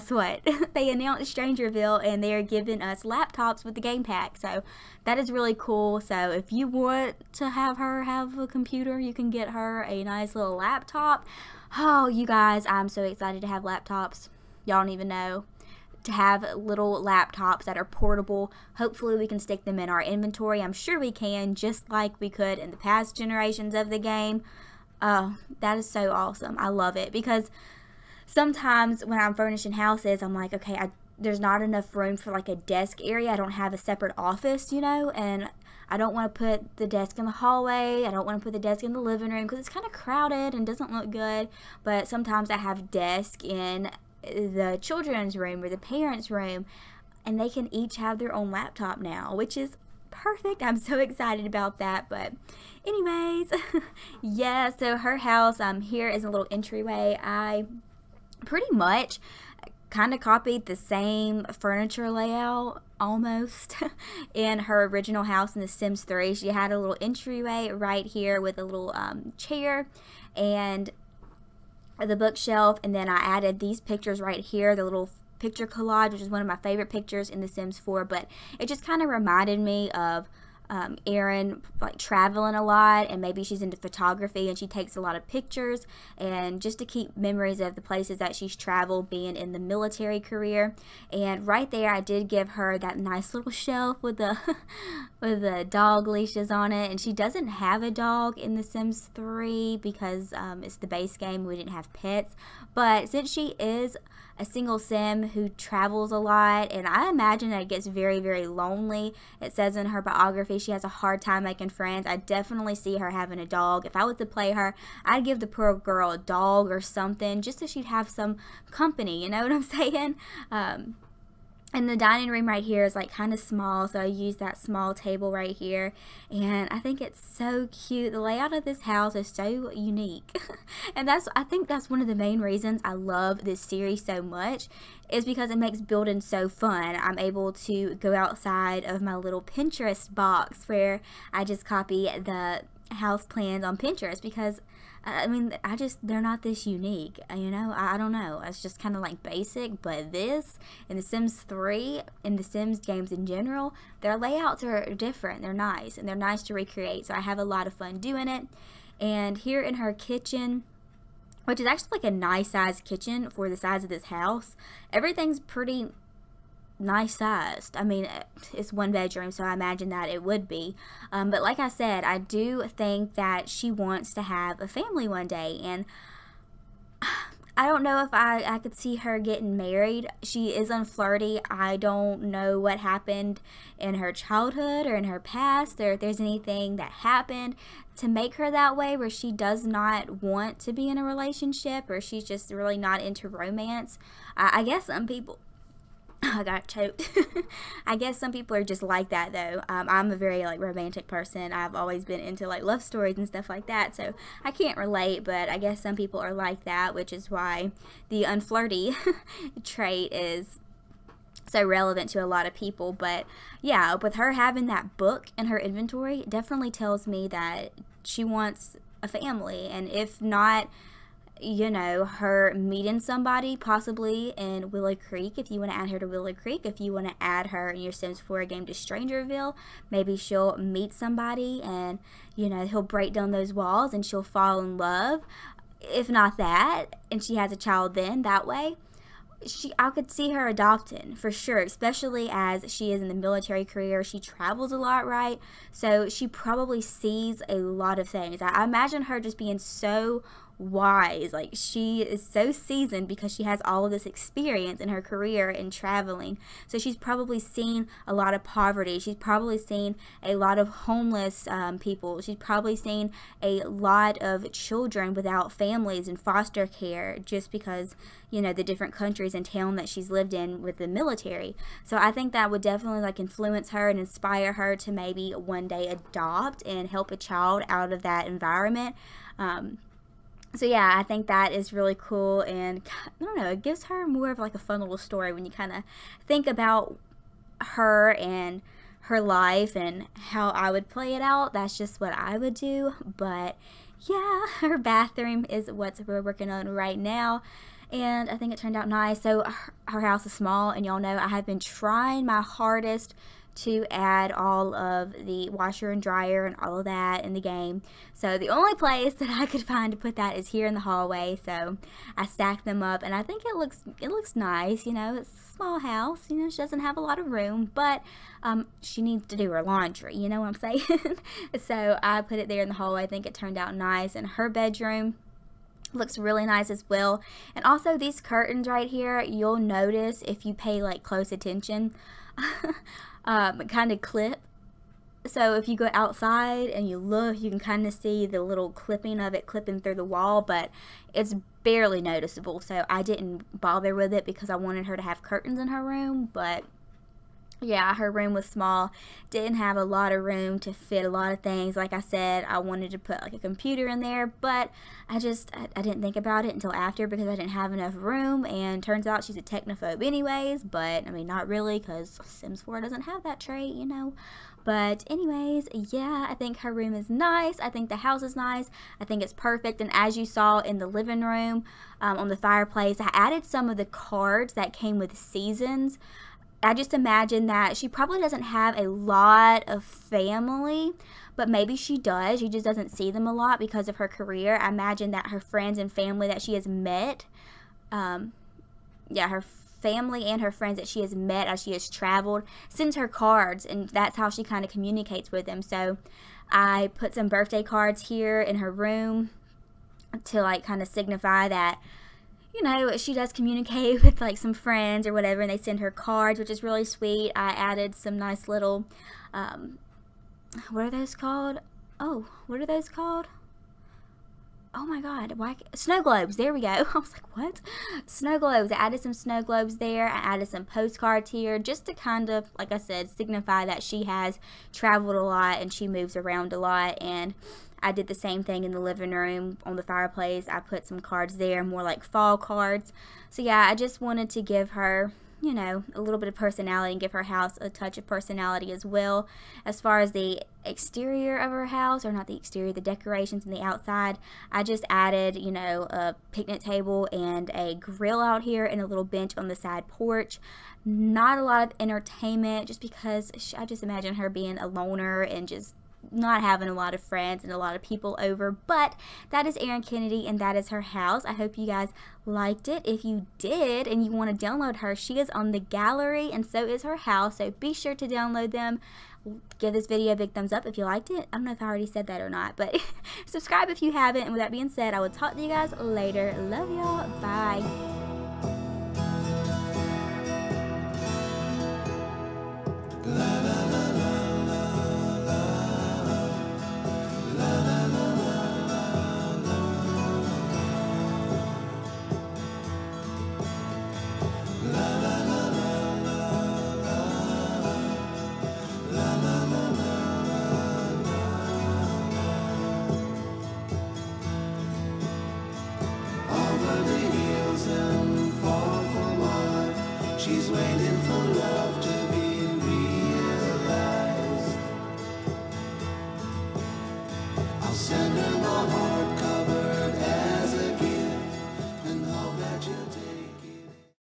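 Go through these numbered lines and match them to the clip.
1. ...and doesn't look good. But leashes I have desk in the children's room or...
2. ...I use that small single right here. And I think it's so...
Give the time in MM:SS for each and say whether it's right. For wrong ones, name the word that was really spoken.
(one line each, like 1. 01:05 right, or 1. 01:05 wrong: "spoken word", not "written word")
1. 00:40 wrong: "sometimes", not "leashes"
2. 02:03 wrong: "table", not "single".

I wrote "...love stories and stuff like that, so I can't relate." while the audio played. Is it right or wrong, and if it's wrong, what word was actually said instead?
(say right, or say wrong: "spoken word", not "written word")
right.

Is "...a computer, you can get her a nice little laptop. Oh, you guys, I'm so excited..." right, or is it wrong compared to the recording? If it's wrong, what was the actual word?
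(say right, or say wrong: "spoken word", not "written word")
right.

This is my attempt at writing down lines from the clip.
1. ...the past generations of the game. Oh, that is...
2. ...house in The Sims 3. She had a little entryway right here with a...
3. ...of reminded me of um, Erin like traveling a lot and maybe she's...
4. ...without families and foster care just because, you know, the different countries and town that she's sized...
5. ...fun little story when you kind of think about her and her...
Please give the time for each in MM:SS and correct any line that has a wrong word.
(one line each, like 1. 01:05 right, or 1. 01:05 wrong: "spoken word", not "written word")
1. 00:22 right
2. 01:05 right
3. 01:19 right
4. 04:25 wrong: "lived", not "sized"
5. 04:44 right.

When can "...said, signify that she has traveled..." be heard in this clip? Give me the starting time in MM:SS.
07:02.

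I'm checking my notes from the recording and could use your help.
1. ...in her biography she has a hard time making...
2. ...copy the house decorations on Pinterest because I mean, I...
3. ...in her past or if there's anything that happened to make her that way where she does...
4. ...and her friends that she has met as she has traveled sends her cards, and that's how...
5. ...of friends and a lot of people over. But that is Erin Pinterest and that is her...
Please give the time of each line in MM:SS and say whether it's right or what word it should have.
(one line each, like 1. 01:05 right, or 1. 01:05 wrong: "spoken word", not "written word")
1. 01:49 right
2. 02:21 wrong: "plans", not "decorations"
3. 03:04 right
4. 06:30 right
5. 07:36 wrong: "Kennedy", not "Pinterest".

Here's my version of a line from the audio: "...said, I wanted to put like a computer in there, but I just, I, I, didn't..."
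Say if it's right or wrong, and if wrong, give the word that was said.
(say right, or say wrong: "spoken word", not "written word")
right.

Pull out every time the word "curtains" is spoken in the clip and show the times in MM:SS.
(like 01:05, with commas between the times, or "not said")
05:28, 05:45.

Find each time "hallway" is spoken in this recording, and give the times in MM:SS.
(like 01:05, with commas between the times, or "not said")
00:37, 05:10, 05:22.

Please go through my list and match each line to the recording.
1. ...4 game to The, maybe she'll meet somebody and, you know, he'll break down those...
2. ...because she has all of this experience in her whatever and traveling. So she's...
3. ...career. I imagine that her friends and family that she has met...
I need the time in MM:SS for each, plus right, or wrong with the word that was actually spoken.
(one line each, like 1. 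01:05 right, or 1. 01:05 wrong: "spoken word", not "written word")
1. 03:48 wrong: "Strangerville", not "The"
2. 04:13 wrong: "career", not "whatever"
3. 06:24 right.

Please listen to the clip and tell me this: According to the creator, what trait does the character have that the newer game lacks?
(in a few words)
technophobe.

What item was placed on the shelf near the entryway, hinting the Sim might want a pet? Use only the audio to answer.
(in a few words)
dog leashes.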